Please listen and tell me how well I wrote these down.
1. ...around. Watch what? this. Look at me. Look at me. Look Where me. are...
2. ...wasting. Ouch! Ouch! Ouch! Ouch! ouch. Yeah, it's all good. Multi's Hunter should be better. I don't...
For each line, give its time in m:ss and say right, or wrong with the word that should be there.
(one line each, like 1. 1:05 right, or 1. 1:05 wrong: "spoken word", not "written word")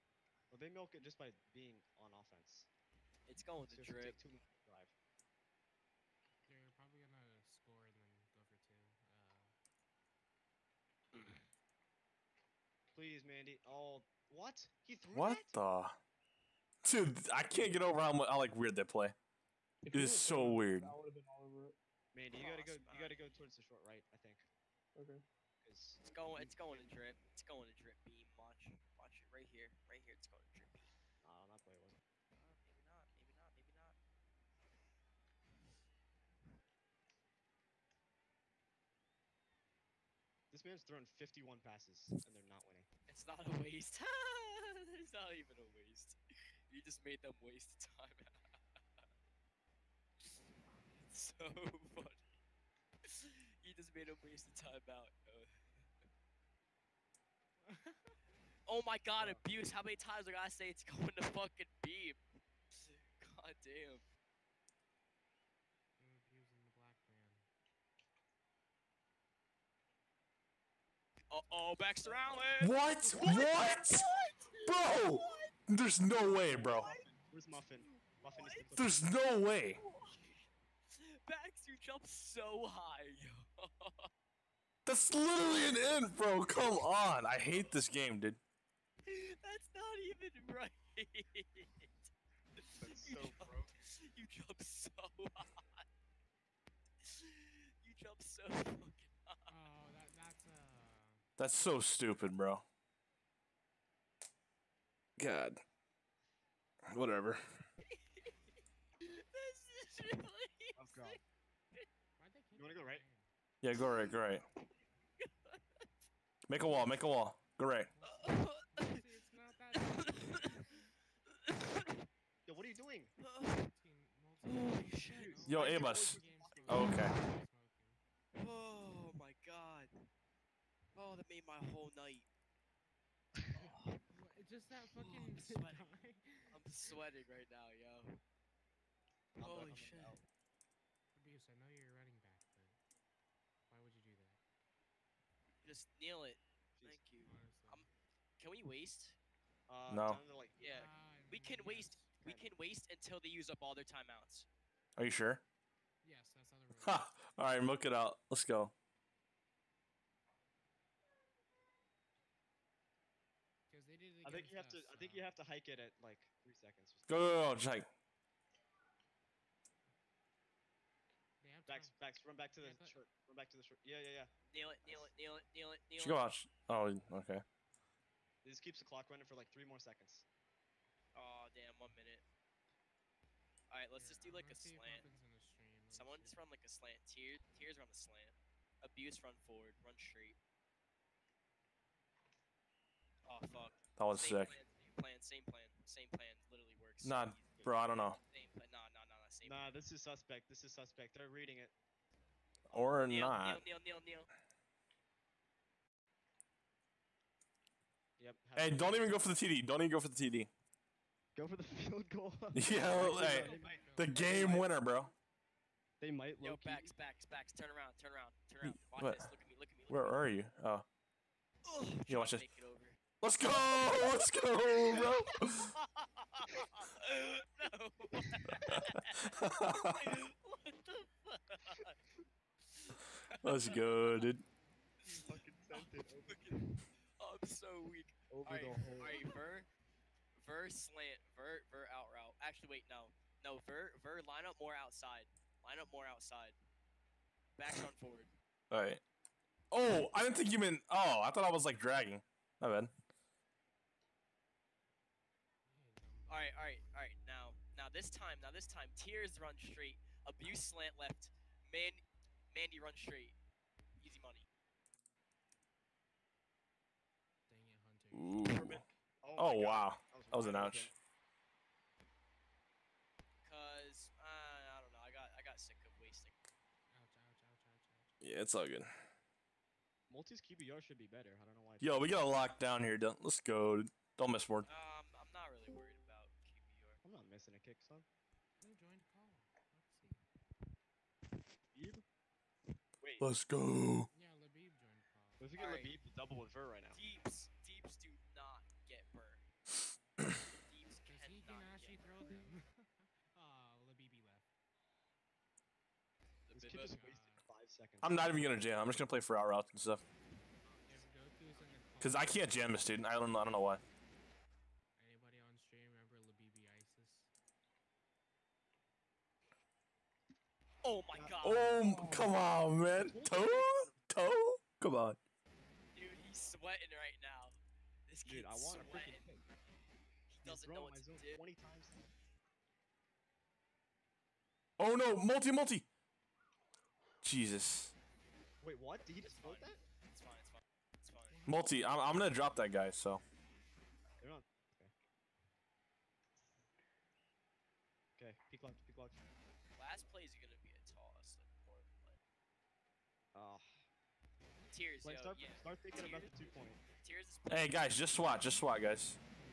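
1. 3:38 right
2. 4:36 wrong: "QBR", not "Hunter".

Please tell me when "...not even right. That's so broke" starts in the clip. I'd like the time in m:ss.
1:29.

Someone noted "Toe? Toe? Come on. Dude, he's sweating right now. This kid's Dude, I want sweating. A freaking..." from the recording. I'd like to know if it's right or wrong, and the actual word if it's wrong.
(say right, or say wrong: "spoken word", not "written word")
right.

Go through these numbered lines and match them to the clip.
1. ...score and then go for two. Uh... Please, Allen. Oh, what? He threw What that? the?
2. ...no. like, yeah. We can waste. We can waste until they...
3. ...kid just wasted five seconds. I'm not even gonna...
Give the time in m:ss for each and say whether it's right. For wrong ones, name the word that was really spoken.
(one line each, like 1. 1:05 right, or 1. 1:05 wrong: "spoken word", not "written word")
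1. 0:07 wrong: "Mandy", not "Allen"
2. 2:29 right
3. 5:06 right.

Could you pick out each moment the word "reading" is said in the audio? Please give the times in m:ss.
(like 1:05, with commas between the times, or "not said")
3:21.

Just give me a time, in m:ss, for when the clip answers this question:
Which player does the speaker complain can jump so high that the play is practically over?
1:11.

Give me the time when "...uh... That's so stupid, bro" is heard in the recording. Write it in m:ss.
1:40.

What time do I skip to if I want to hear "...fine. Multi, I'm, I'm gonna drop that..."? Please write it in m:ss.
5:41.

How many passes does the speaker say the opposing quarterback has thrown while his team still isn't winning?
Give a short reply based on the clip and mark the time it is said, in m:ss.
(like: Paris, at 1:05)
51, at 0:41.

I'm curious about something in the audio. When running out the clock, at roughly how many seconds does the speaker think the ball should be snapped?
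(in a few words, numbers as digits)
3 seconds.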